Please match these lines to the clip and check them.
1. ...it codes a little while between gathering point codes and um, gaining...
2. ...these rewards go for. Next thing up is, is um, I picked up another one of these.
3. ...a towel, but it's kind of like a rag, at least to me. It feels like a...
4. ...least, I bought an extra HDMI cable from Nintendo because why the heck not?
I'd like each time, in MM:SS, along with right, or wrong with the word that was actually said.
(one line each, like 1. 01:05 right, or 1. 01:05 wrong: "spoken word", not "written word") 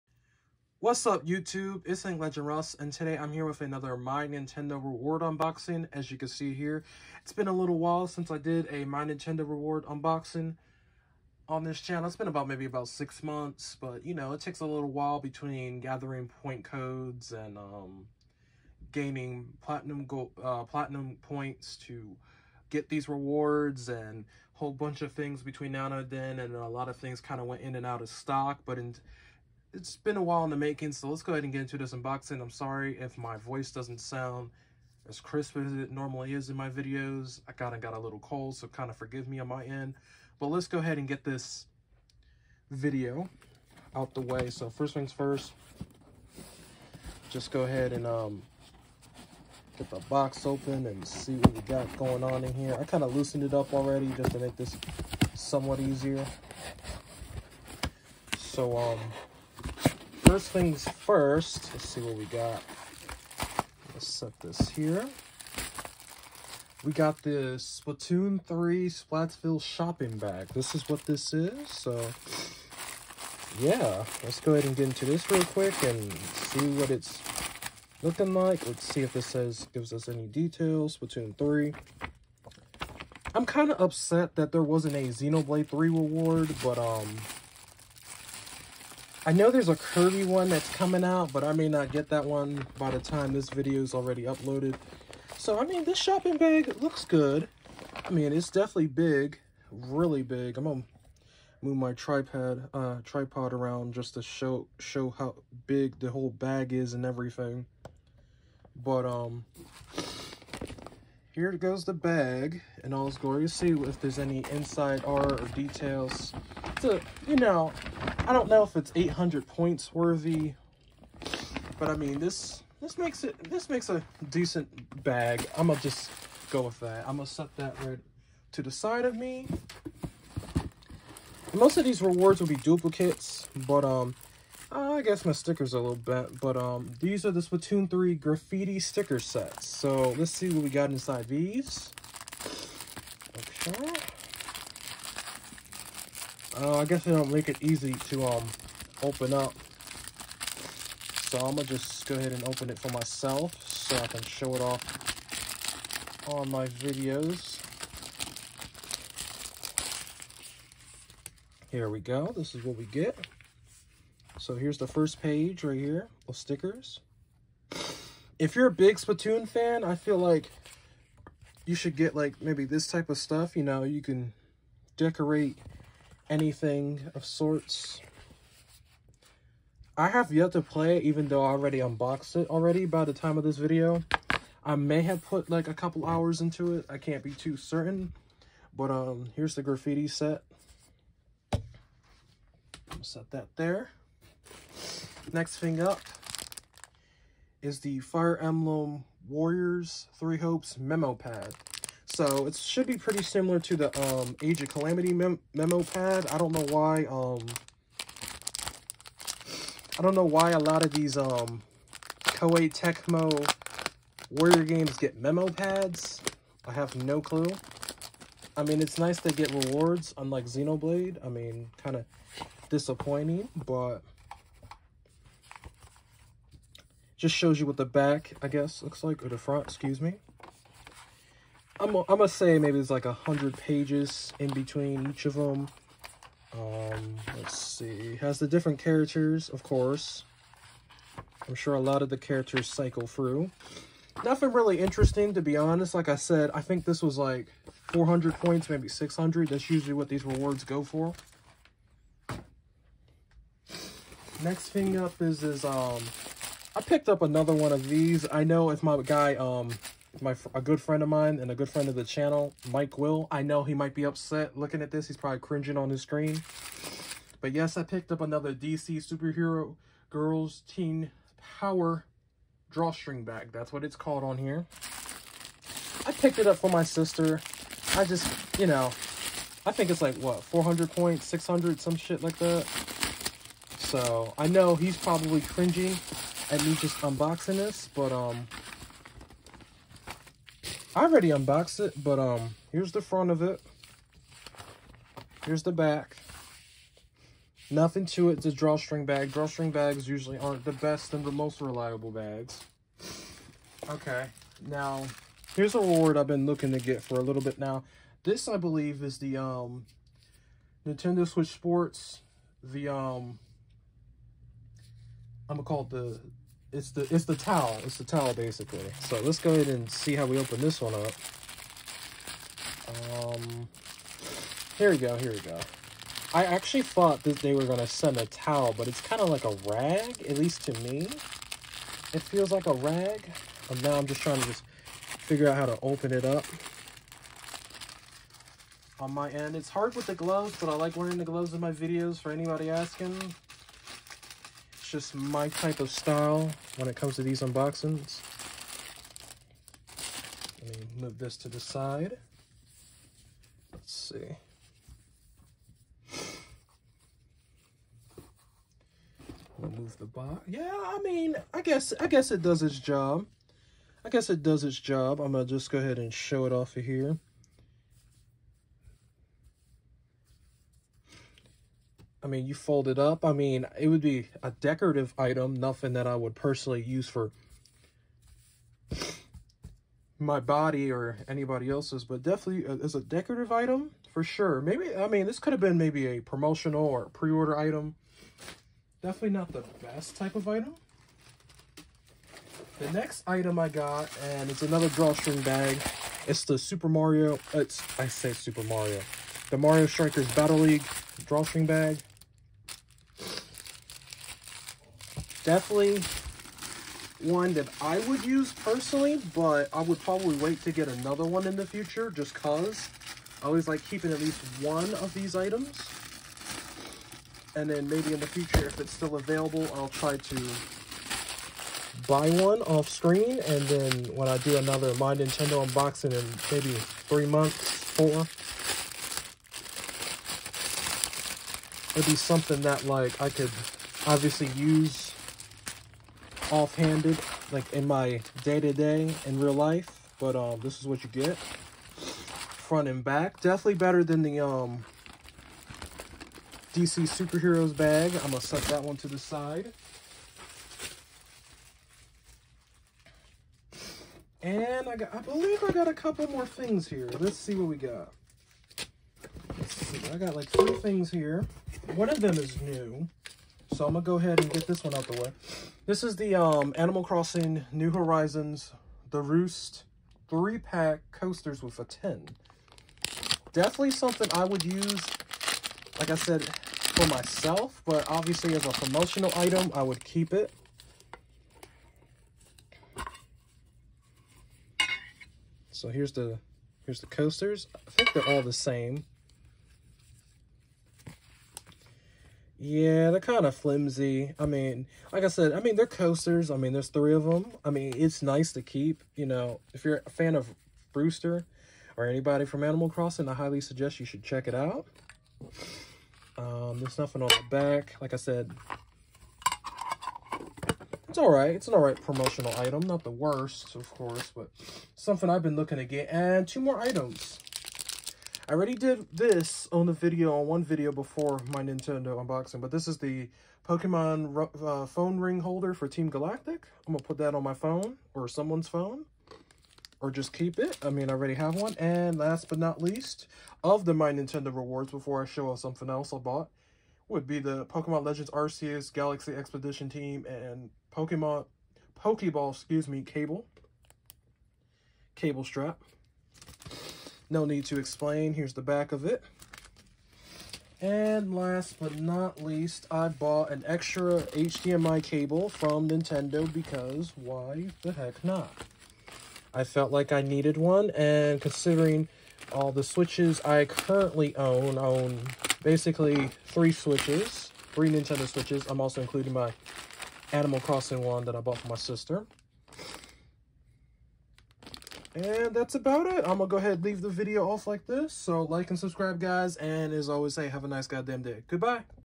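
1. 00:14 wrong: "takes", not "codes"
2. 04:10 right
3. 05:28 right
4. 09:12 right.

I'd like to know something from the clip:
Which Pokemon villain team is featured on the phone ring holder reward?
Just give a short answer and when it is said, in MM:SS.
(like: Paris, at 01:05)
Team Galactic, at 08:45.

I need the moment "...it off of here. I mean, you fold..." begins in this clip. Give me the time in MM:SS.
06:06.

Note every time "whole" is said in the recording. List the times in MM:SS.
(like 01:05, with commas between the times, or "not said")
00:24, 01:46.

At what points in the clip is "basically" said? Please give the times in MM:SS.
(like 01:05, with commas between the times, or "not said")
05:18, 09:25.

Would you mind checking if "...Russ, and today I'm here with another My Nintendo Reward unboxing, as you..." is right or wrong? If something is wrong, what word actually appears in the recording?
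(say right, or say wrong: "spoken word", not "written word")
right.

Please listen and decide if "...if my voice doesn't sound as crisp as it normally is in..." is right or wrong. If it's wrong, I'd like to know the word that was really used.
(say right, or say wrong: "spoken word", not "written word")
right.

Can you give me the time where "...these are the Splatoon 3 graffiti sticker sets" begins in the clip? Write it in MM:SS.
02:17.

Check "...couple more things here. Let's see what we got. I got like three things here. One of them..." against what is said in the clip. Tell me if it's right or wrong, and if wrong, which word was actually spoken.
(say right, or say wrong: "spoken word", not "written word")
right.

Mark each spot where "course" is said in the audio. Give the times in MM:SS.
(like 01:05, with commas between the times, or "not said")
03:59, 08:33.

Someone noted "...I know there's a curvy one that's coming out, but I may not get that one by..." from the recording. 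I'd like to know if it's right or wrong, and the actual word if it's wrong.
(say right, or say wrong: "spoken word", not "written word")
right.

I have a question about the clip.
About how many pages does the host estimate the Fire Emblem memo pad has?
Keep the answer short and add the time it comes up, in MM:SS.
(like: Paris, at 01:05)
100, at 03:53.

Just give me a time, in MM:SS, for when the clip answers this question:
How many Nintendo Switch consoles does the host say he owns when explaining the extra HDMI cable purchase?
09:26.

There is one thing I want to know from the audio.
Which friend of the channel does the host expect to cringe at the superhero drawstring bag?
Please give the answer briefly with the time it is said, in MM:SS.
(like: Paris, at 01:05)
Mike Will, at 04:22.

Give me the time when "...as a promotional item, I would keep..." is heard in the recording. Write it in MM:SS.
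07:58.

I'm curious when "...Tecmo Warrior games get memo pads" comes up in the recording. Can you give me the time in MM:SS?
03:32.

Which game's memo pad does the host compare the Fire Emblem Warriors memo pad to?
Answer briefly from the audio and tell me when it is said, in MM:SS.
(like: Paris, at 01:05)
Age of Calamity, at 03:24.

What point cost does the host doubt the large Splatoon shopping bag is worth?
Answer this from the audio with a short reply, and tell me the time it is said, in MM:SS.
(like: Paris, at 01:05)
800, at 01:58.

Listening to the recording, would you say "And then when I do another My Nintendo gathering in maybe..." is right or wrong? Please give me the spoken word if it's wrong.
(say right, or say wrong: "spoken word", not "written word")
wrong: "unboxing", not "gathering".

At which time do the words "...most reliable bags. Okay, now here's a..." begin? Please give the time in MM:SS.
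05:01.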